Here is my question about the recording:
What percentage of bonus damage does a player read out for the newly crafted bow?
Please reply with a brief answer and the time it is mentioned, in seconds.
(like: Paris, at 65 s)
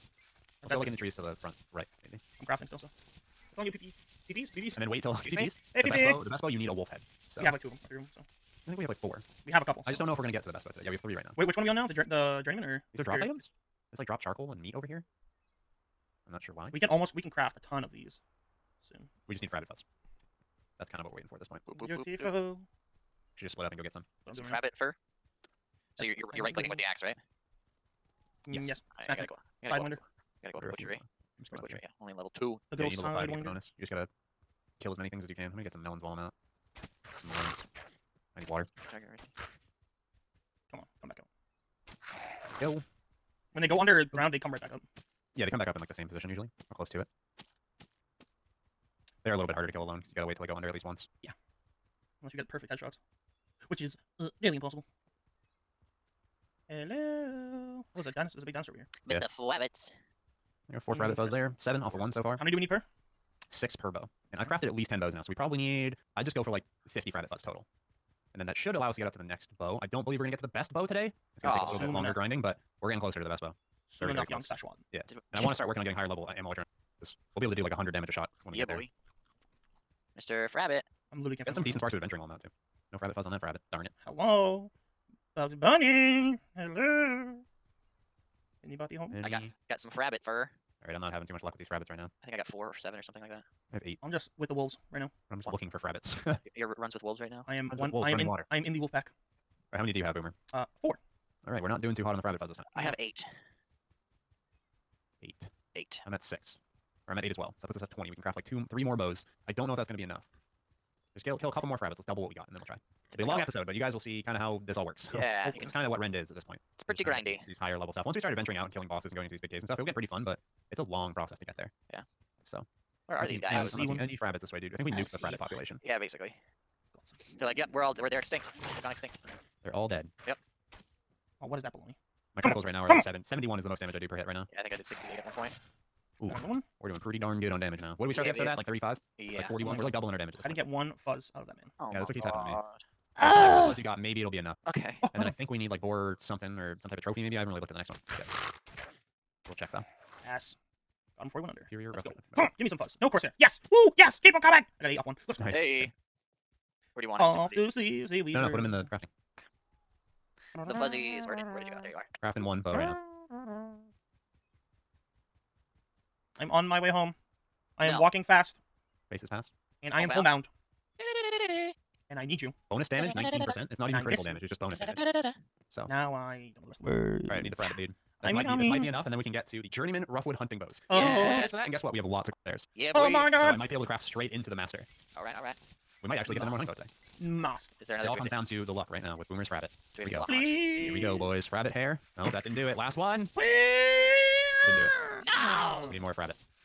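19%, at 173 s.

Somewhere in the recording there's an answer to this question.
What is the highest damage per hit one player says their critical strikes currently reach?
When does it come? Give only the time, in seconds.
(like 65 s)
133 s.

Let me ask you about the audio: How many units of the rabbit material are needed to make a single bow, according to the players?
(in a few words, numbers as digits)
6.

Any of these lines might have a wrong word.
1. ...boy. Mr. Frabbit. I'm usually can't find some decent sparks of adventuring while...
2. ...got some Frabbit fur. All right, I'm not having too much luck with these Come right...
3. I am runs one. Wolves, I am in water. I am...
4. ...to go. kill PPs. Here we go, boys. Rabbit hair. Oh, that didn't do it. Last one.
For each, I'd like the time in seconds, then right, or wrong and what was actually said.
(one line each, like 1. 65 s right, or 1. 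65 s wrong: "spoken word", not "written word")
1. 78 s wrong: "literally", not "usually"
2. 89 s wrong: "Frabbits", not "Come"
3. 97 s right
4. 190 s wrong: "Please", not "PPs".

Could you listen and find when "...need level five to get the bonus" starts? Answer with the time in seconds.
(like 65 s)
32 s.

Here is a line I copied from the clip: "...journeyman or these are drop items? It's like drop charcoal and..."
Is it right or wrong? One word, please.
right.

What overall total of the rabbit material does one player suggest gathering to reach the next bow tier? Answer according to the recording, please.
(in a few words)
50.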